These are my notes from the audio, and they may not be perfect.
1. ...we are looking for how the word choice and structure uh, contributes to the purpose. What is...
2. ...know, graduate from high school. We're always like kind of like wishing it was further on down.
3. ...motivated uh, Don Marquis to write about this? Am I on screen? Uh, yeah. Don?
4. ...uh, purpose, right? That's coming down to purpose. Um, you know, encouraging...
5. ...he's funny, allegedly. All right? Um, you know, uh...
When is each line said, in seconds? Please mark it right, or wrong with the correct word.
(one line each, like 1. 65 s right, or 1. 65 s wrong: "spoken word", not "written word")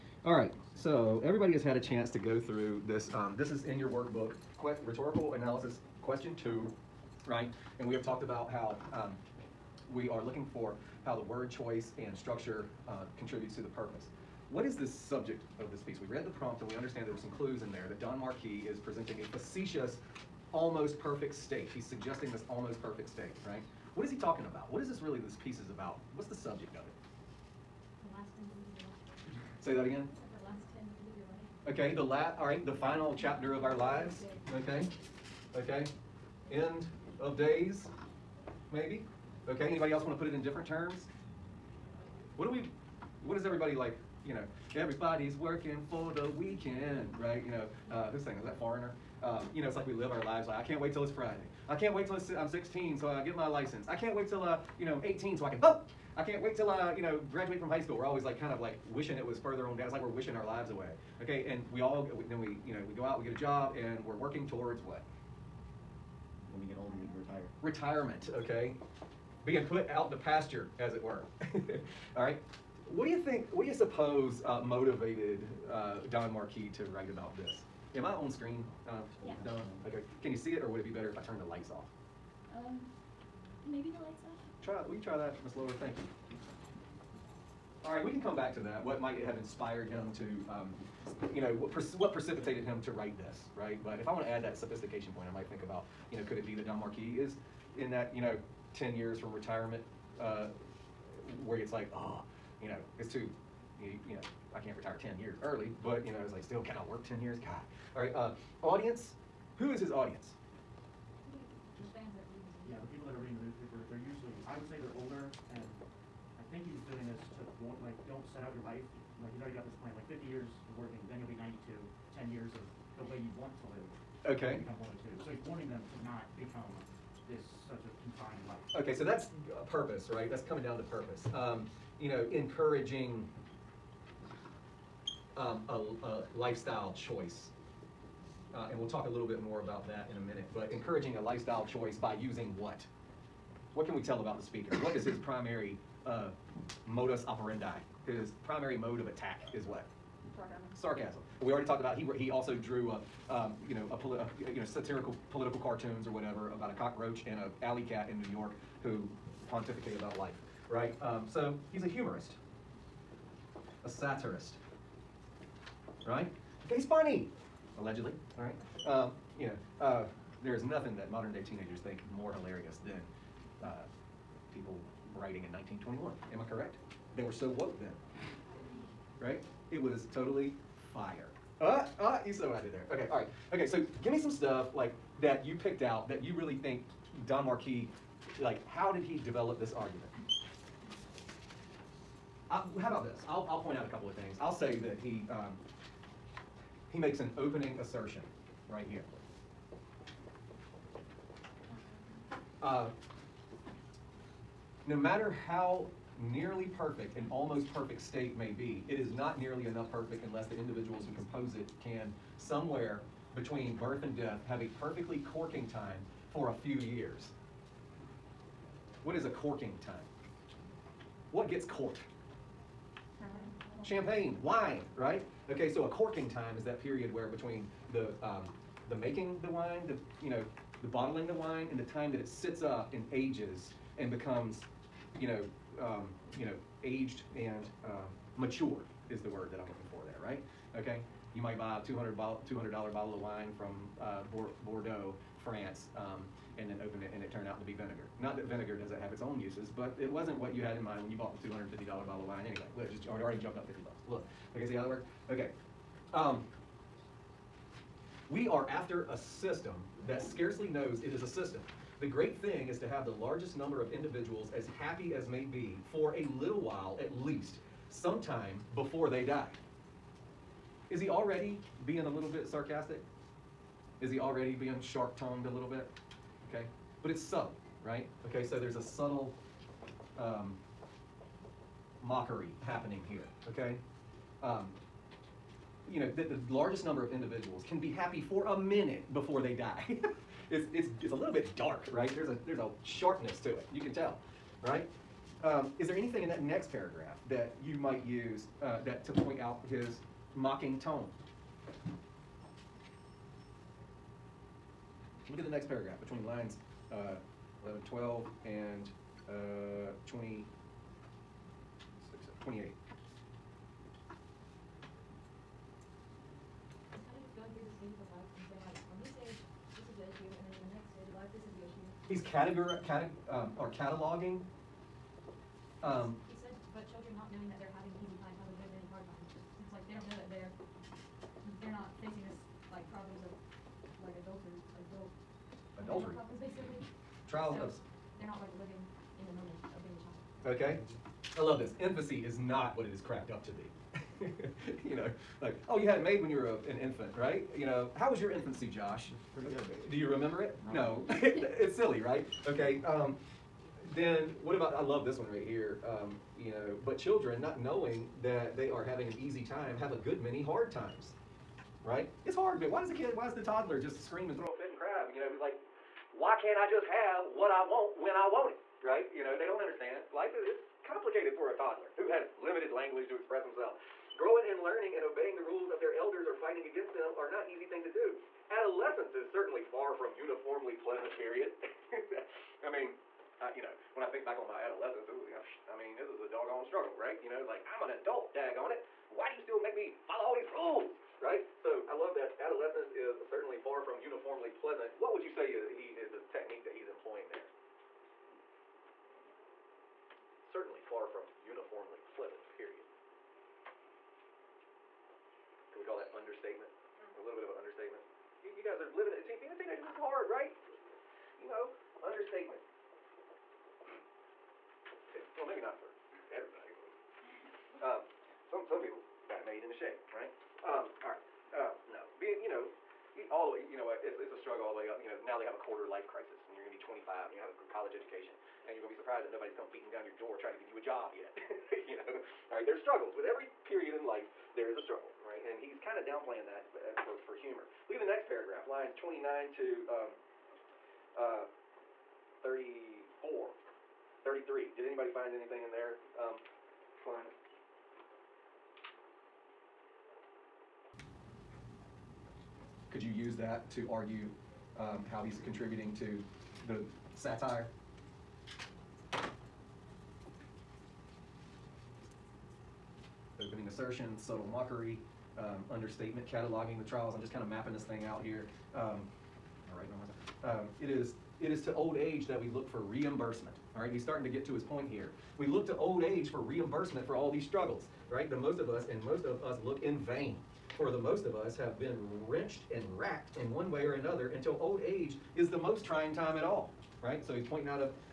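1. 9 s right
2. 57 s right
3. 74 s right
4. 129 s right
5. 166 s right.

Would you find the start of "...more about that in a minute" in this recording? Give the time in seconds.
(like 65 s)
139 s.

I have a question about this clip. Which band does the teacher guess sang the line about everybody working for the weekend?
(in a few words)
Foreigner.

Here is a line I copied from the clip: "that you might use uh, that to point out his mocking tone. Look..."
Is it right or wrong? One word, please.
right.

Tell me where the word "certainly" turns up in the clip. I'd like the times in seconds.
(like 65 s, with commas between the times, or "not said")
379 s, 393 s, 400 s.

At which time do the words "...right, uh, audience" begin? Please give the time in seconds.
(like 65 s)
108 s.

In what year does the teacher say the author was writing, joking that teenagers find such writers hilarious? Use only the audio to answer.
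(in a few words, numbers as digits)
1921.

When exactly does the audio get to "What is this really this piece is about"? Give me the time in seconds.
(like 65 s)
24 s.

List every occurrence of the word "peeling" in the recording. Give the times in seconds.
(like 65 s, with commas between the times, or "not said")
not said.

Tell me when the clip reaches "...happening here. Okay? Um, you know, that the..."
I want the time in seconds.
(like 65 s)
282 s.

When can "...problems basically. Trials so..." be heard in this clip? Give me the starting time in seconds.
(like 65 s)
336 s.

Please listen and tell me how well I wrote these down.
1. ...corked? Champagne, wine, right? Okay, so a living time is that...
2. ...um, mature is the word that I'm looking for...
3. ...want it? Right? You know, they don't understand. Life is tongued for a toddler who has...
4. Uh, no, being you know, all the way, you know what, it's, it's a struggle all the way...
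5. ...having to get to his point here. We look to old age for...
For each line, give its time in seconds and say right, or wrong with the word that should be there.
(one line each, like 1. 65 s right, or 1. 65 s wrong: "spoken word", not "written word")
1. 221 s wrong: "corking", not "living"
2. 237 s right
3. 368 s wrong: "complicated", not "tongued"
4. 421 s right
5. 474 s wrong: "starting", not "having".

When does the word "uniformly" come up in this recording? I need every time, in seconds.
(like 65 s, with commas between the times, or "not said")
380 s, 394 s, 401 s.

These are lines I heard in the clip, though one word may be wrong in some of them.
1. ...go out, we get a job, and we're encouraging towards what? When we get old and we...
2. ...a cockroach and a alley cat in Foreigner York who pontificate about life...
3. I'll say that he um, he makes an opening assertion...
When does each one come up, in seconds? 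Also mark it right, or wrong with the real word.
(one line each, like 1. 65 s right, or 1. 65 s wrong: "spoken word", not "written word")
1. 62 s wrong: "working", not "encouraging"
2. 156 s wrong: "New", not "Foreigner"
3. 194 s right.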